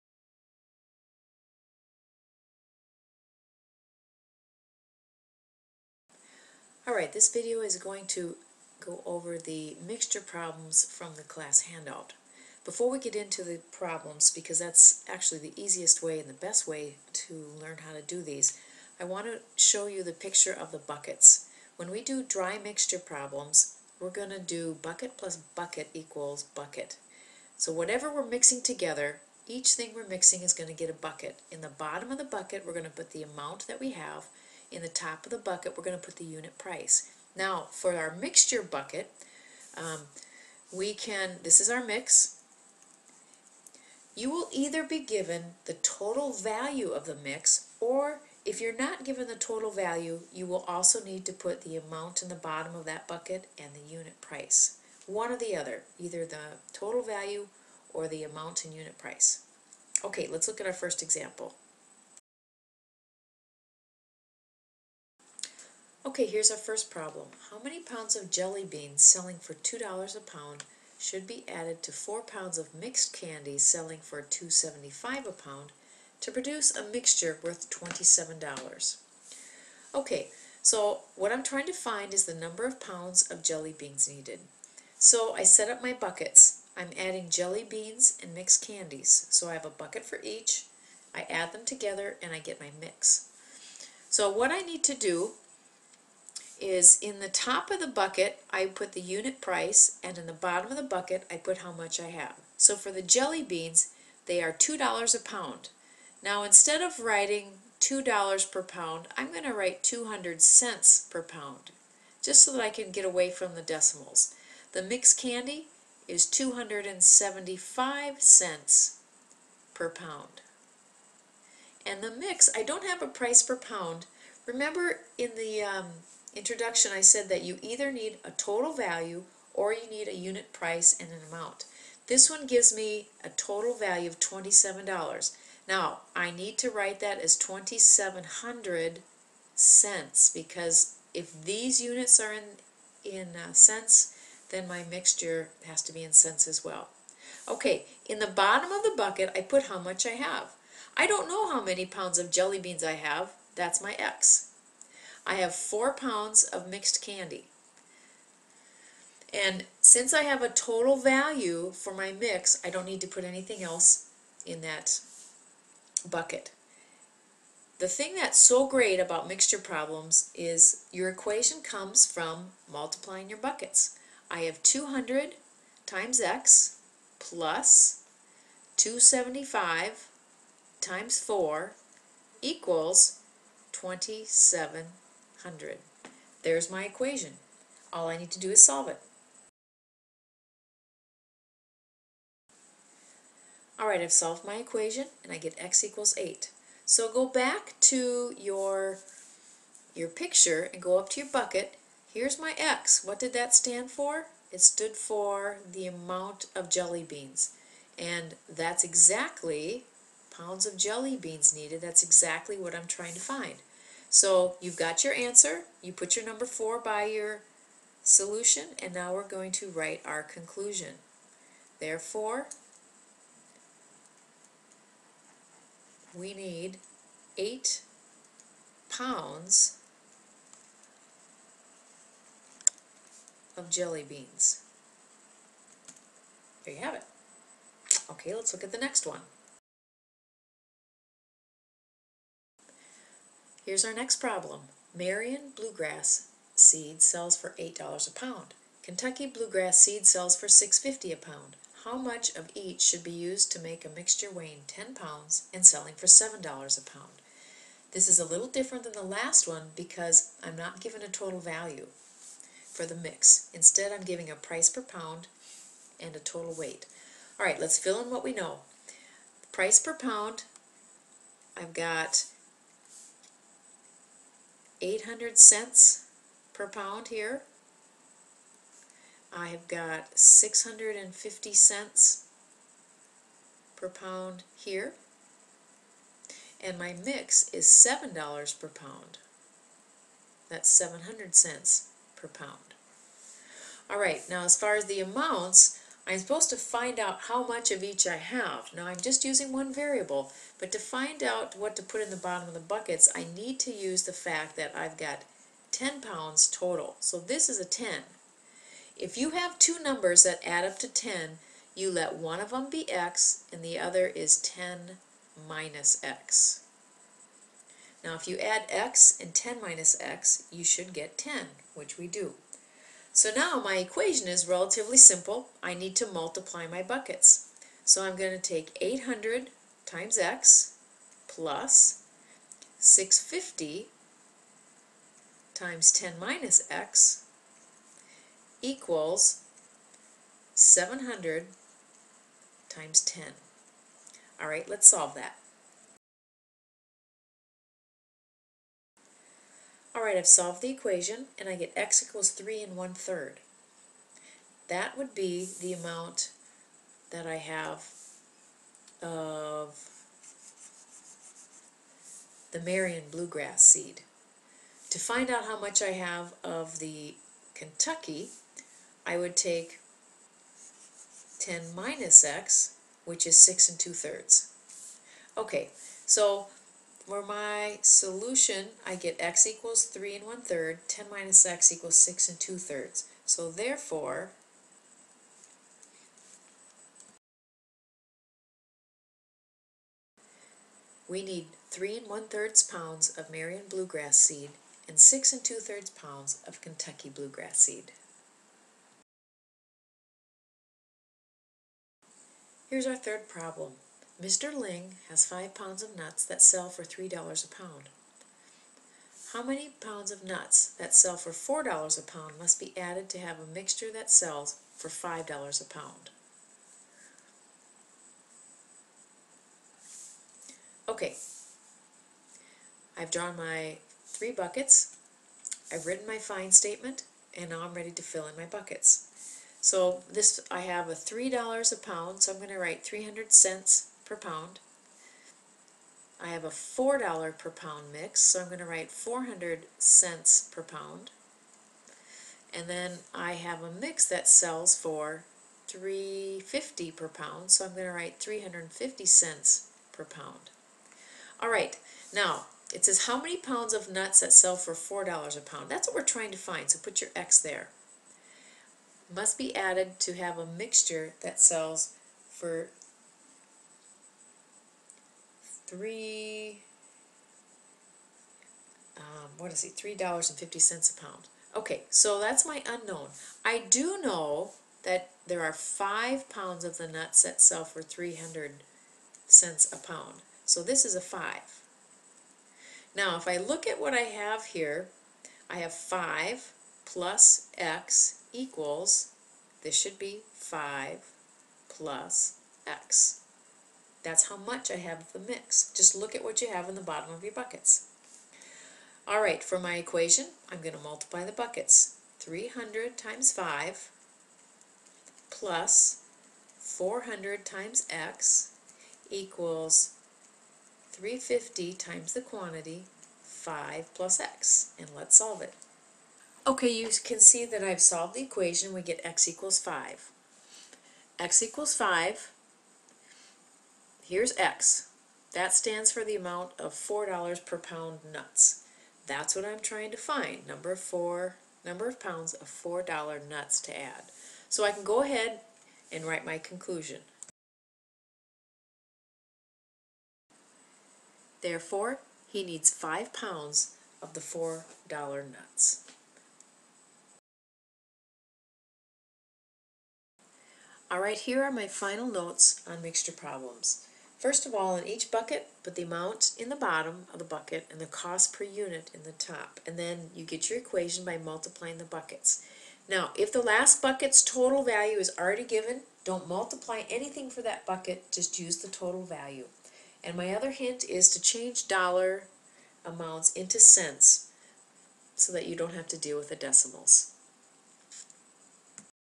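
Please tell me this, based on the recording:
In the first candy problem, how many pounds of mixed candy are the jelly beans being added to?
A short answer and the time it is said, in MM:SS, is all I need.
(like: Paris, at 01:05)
4 pounds, at 01:11.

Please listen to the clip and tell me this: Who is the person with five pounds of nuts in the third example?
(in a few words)
Mr. Ling.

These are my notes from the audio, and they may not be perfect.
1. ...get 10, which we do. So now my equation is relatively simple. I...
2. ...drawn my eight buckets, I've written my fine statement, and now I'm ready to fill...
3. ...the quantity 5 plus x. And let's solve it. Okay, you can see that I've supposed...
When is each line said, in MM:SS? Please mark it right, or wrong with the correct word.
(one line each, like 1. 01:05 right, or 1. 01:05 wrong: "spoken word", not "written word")
1. 05:20 right
2. 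07:03 wrong: "three", not "eight"
3. 08:32 wrong: "solved", not "supposed".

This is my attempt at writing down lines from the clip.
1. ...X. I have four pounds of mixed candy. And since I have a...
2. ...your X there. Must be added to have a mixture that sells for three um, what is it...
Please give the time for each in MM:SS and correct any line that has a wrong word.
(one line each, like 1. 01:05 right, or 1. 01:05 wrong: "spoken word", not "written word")
1. 02:33 right
2. 07:36 right.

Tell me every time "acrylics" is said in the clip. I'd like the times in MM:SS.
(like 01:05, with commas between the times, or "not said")
not said.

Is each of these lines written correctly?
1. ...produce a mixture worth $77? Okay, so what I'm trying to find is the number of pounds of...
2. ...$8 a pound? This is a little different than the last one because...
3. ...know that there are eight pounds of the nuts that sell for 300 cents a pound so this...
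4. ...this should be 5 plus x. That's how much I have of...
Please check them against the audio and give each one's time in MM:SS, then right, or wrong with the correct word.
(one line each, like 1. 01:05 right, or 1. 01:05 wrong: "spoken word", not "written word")
1. 01:16 wrong: "27", not "77"
2. 04:16 wrong: "7", not "8"
3. 07:54 wrong: "five", not "eight"
4. 08:09 right.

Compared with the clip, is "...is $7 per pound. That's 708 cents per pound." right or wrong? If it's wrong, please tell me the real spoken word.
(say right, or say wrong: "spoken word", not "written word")
wrong: "700", not "708".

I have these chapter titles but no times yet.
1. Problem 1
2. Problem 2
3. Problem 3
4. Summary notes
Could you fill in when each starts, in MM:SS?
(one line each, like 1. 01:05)
1. 01:03
2. 04:01
3. 06:41
4. 09:10.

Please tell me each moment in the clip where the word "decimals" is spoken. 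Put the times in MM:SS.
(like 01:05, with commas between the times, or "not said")
01:53, 09:36.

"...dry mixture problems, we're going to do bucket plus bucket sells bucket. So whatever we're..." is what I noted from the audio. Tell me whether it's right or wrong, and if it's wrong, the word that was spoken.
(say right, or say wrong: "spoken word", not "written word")
wrong: "equals", not "sells".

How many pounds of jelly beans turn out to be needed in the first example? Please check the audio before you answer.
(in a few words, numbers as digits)
8 pounds.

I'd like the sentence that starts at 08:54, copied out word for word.
So I can go ahead and write my conclusion.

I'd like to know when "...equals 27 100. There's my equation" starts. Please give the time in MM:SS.
03:02.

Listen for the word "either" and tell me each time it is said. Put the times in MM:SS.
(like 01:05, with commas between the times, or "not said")
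00:44, 00:55, 02:07.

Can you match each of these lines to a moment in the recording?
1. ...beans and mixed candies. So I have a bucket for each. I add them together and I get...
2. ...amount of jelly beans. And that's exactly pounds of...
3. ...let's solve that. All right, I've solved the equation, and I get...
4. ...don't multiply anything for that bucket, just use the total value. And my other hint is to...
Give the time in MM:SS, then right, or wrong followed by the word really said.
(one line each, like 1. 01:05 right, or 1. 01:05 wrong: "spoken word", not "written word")
1. 01:27 right
2. 03:25 right
3. 05:44 right
4. 09:26 right.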